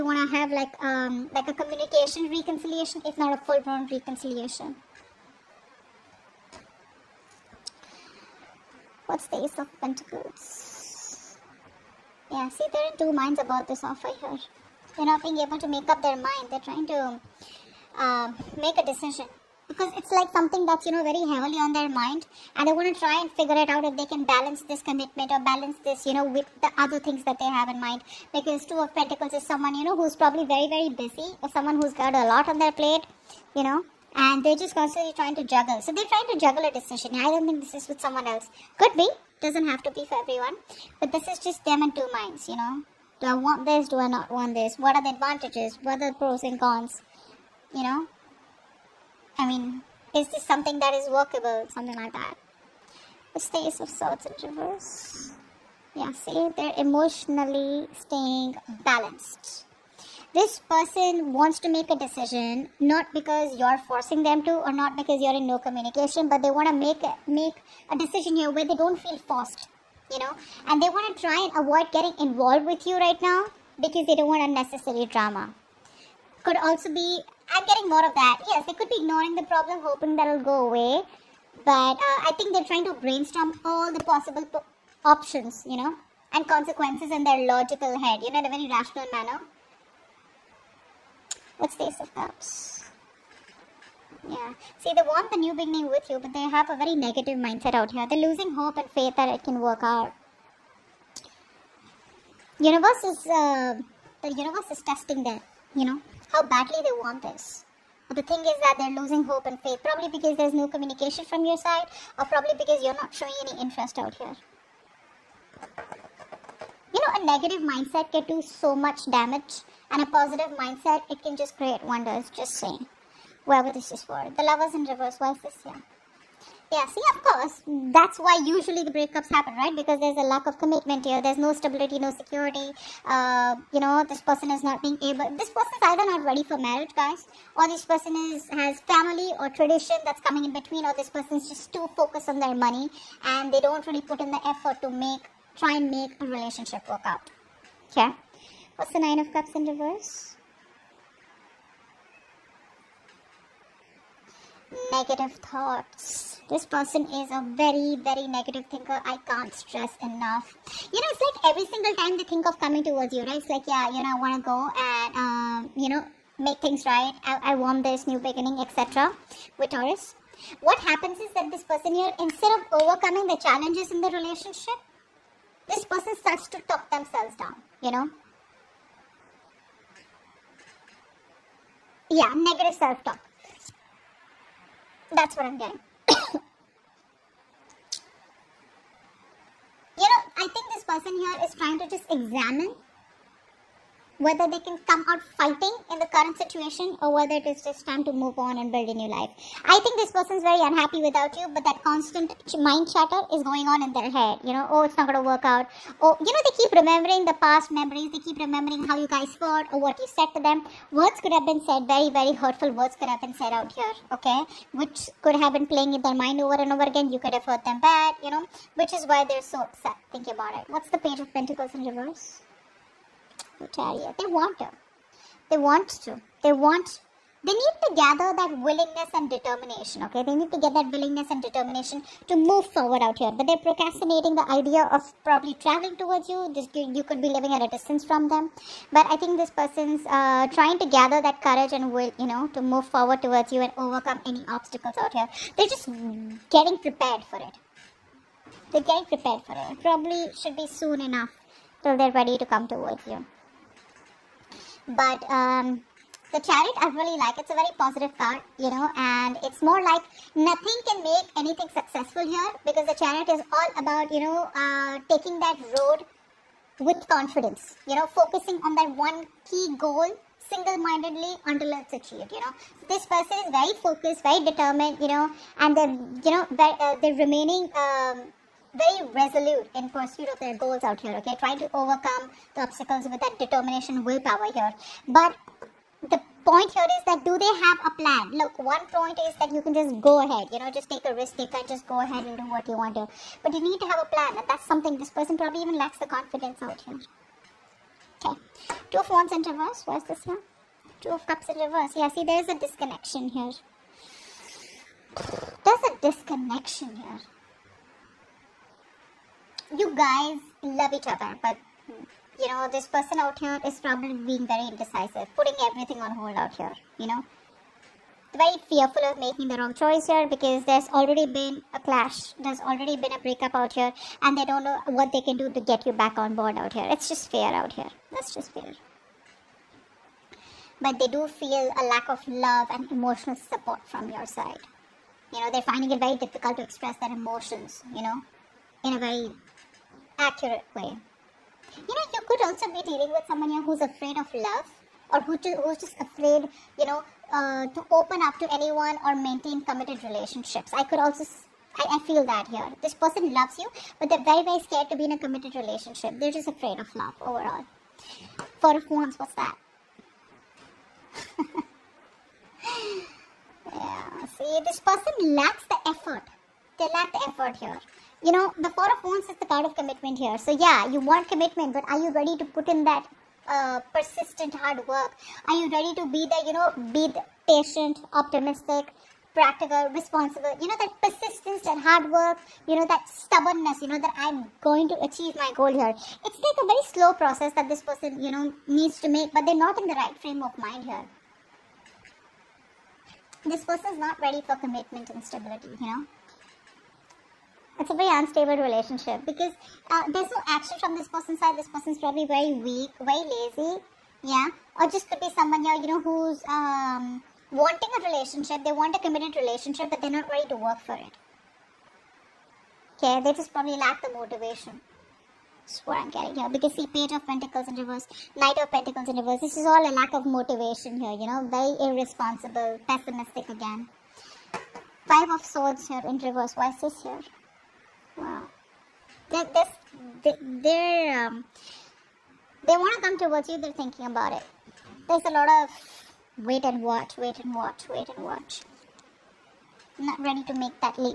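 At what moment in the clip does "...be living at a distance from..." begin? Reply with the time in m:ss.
3:57.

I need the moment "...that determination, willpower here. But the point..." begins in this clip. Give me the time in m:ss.
4:43.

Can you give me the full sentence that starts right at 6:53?
Okay, they just probably lack the motivation.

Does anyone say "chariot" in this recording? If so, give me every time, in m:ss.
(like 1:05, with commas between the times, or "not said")
4:16, 4:22.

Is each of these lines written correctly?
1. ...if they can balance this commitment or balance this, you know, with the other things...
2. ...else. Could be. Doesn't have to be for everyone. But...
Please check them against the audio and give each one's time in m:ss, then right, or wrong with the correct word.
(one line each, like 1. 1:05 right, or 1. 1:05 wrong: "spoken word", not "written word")
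1. 0:23 right
2. 0:38 right.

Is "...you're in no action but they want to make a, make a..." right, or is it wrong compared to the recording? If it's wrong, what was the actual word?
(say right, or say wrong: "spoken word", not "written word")
wrong: "communication", not "action".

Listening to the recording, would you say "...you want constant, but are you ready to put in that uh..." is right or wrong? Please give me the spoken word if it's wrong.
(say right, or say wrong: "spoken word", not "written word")
wrong: "commitment", not "constant".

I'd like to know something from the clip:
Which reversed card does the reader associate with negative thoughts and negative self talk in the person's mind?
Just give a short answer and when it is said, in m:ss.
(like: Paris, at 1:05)
Nine of Cups, at 2:28.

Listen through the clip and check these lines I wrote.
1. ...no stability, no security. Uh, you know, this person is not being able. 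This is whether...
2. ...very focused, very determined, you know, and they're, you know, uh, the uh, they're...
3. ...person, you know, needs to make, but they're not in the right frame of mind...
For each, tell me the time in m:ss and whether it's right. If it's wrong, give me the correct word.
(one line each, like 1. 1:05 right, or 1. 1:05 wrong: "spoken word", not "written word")
1. 2:11 wrong: "either", not "whether"
2. 4:33 right
3. 6:27 right.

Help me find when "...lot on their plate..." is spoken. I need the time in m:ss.
0:32.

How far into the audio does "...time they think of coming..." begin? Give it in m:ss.
2:41.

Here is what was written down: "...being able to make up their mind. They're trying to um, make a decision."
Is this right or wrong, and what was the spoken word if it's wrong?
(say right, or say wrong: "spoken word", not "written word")
right.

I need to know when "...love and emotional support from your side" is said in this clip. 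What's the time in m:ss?
5:32.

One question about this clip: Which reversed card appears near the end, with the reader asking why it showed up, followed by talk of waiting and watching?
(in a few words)
Five of Swords.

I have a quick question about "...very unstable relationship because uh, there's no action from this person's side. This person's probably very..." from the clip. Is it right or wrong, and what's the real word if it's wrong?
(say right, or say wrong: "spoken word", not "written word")
right.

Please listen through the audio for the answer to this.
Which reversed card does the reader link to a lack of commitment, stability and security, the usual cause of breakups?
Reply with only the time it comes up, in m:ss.
2:04.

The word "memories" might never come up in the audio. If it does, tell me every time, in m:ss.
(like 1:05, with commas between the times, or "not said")
3:27.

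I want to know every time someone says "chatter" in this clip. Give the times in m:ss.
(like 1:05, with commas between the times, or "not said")
3:22.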